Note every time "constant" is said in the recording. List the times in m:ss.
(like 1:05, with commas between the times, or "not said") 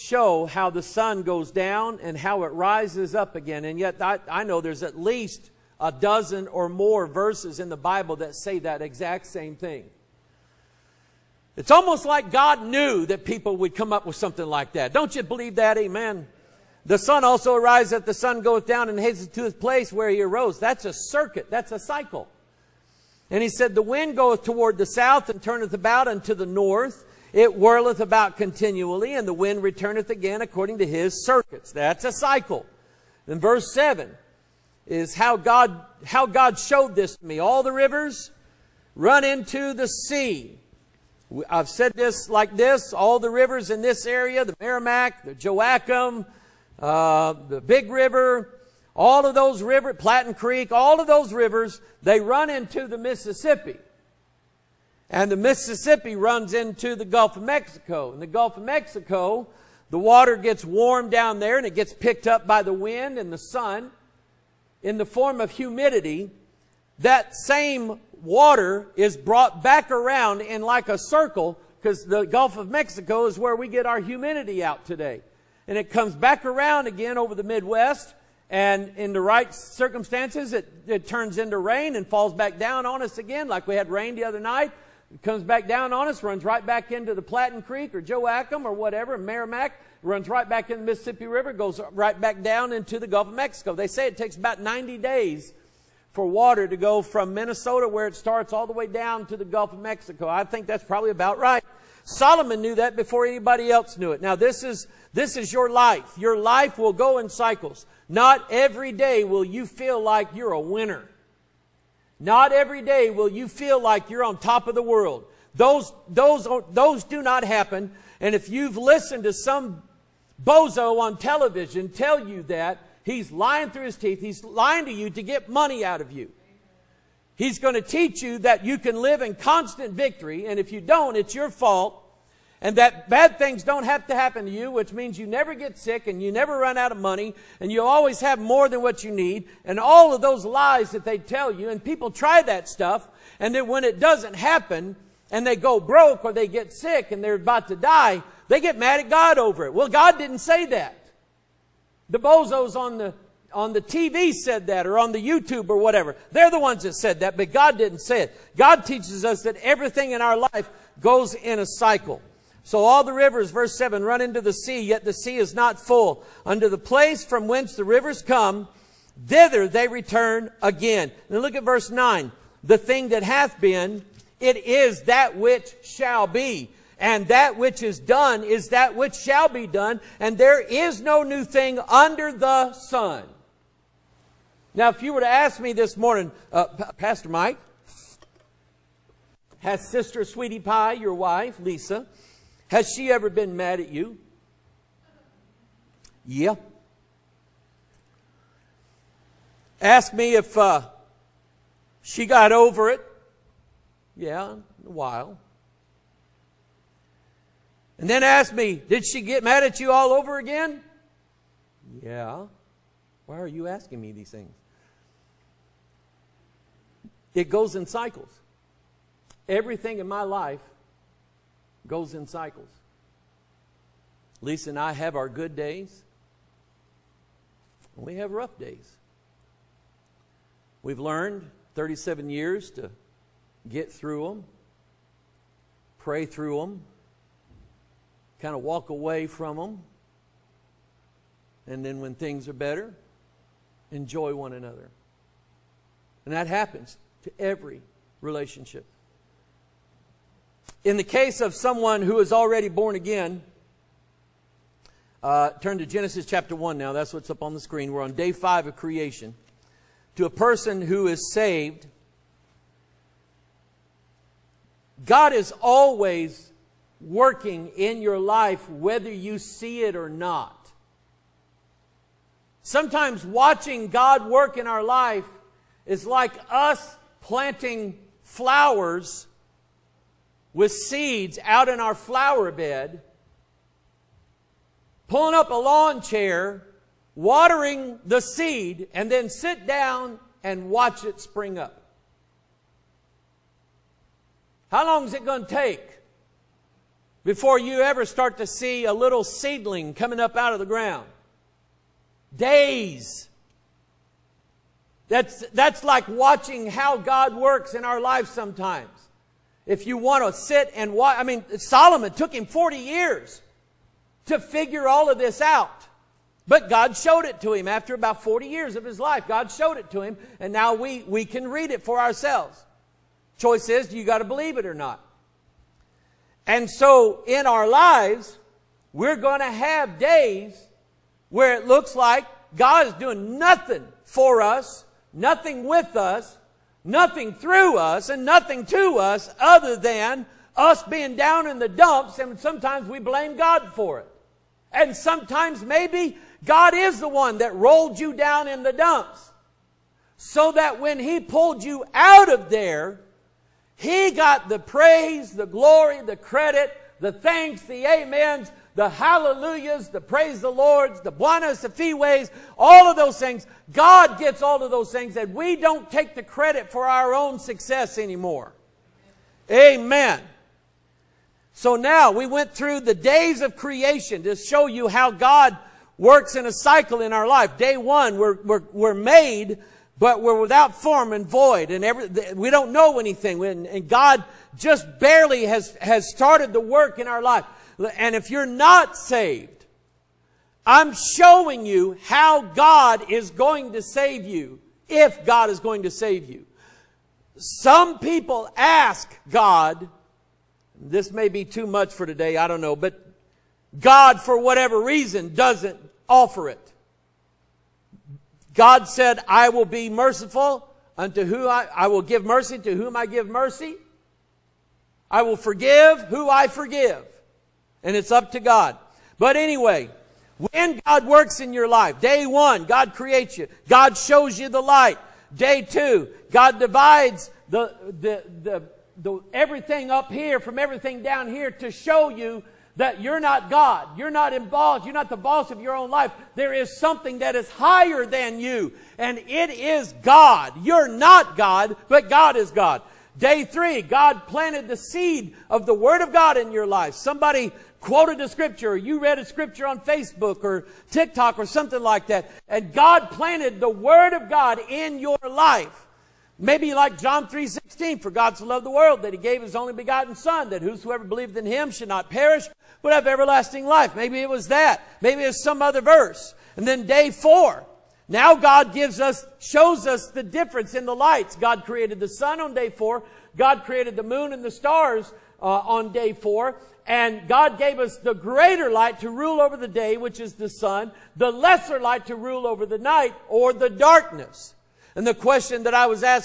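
2:09.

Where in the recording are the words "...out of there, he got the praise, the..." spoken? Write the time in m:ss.
5:51.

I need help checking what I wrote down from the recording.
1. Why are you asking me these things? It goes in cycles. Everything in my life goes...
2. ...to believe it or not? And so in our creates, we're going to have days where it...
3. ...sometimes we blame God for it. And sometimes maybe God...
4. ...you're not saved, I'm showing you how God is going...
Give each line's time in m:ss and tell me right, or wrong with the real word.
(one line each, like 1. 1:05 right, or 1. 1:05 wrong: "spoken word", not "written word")
1. 3:33 right
2. 5:24 wrong: "lives", not "creates"
3. 5:42 right
4. 6:28 right.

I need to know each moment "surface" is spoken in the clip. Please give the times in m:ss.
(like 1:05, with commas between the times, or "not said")
not said.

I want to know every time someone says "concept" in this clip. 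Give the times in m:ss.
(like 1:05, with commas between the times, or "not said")
not said.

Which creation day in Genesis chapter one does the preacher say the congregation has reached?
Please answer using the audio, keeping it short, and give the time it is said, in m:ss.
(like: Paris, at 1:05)
Day 5, at 4:18.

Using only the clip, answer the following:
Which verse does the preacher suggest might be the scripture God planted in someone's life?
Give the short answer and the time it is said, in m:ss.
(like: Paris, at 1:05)
John 3:16, at 7:36.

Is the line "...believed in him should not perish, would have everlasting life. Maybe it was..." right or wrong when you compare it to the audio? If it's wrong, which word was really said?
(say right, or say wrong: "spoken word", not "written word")
right.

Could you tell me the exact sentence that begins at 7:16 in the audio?
There is something that is higher than you, and it is God.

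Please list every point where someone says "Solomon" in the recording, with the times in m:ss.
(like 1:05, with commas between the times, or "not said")
1:42, 5:11.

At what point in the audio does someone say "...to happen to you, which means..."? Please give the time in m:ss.
2:14.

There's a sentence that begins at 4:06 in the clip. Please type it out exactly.
And that happens to every relationship.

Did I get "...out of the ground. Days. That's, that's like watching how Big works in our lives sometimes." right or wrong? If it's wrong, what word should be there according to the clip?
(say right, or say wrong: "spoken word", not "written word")
wrong: "God", not "Big".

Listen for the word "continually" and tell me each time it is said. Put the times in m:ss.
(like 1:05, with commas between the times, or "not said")
0:28.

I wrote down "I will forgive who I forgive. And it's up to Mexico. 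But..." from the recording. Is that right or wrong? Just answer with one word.
wrong.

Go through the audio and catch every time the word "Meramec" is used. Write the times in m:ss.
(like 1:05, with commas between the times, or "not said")
0:44, 1:29.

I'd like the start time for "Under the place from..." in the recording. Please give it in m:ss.
2:46.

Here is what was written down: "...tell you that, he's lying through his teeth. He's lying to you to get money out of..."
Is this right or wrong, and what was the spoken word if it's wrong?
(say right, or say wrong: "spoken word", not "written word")
right.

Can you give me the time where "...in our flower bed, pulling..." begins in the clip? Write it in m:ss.
4:41.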